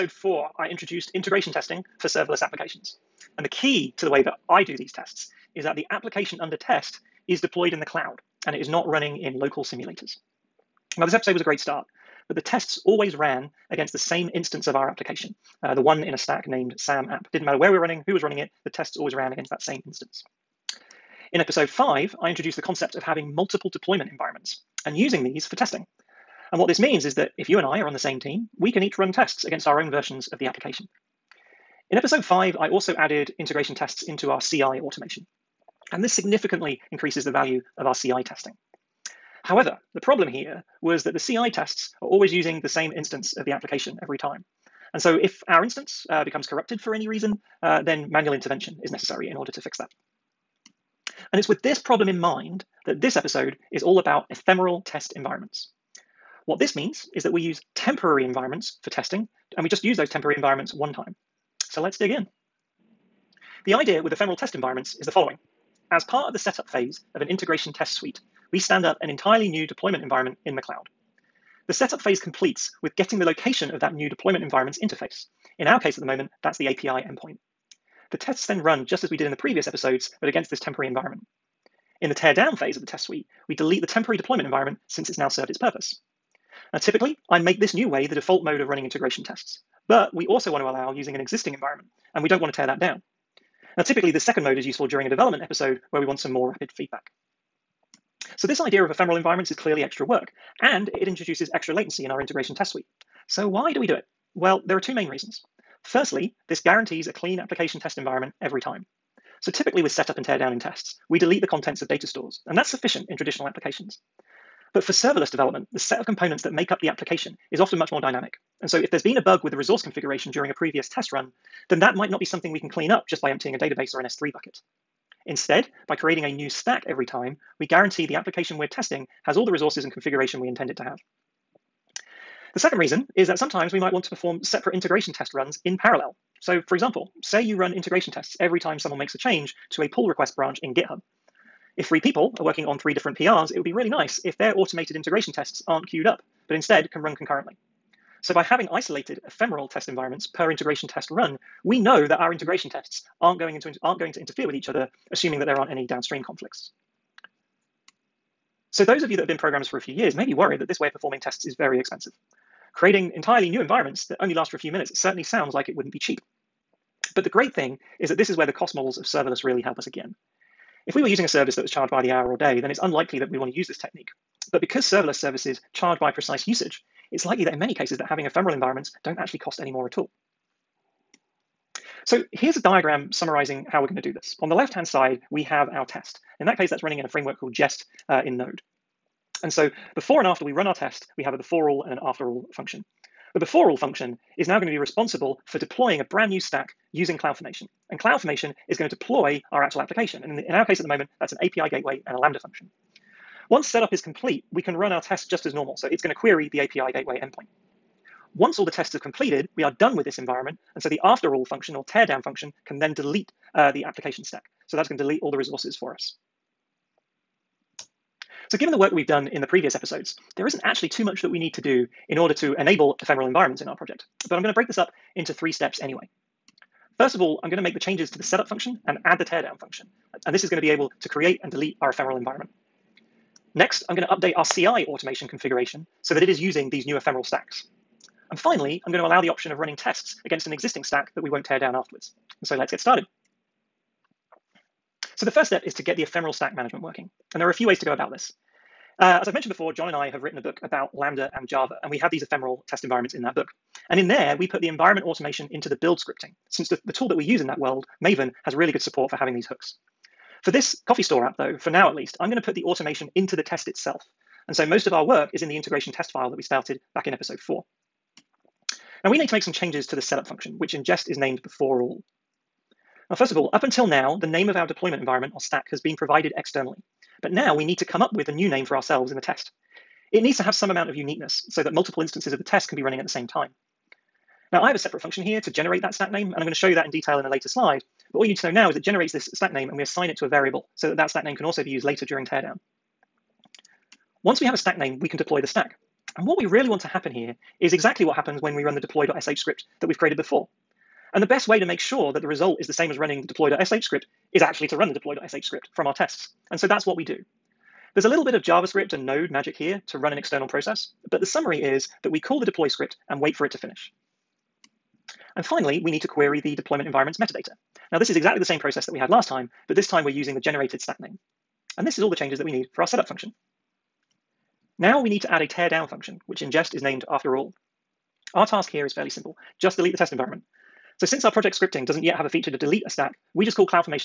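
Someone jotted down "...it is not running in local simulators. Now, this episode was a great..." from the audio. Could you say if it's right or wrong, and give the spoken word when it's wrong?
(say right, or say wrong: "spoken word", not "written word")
right.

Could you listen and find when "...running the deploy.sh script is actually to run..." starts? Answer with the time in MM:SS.
05:02.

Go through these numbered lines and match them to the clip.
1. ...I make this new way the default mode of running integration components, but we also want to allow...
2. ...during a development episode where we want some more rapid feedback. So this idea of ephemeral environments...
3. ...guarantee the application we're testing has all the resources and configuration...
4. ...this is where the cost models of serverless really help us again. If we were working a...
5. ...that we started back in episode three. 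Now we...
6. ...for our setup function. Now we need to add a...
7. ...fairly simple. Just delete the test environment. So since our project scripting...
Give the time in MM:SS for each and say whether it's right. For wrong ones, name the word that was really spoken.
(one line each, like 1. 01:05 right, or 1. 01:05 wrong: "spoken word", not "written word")
1. 01:27 wrong: "tests", not "components"
2. 01:34 right
3. 02:07 right
4. 02:48 wrong: "using", not "working"
5. 04:26 wrong: "four", not "three"
6. 05:22 right
7. 05:28 right.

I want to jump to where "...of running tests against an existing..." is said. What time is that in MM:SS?
03:59.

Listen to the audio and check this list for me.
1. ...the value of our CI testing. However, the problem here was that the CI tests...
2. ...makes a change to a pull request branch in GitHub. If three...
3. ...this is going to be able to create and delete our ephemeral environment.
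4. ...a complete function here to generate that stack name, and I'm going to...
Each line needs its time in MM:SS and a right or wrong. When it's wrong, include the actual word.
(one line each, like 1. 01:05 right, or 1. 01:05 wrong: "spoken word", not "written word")
1. 00:37 right
2. 02:18 right
3. 03:50 right
4. 04:44 wrong: "separate", not "complete".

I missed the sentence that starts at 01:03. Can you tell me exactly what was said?
The idea with ephemeral test environments is the following.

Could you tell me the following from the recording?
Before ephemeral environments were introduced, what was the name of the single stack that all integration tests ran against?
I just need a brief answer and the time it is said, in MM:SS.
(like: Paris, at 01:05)
SAM app, at 00:16.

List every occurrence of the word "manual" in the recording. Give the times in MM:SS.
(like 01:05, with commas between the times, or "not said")
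00:48.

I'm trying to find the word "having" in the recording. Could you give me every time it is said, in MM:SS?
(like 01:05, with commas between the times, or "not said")
00:23, 02:28, 02:58, 04:19.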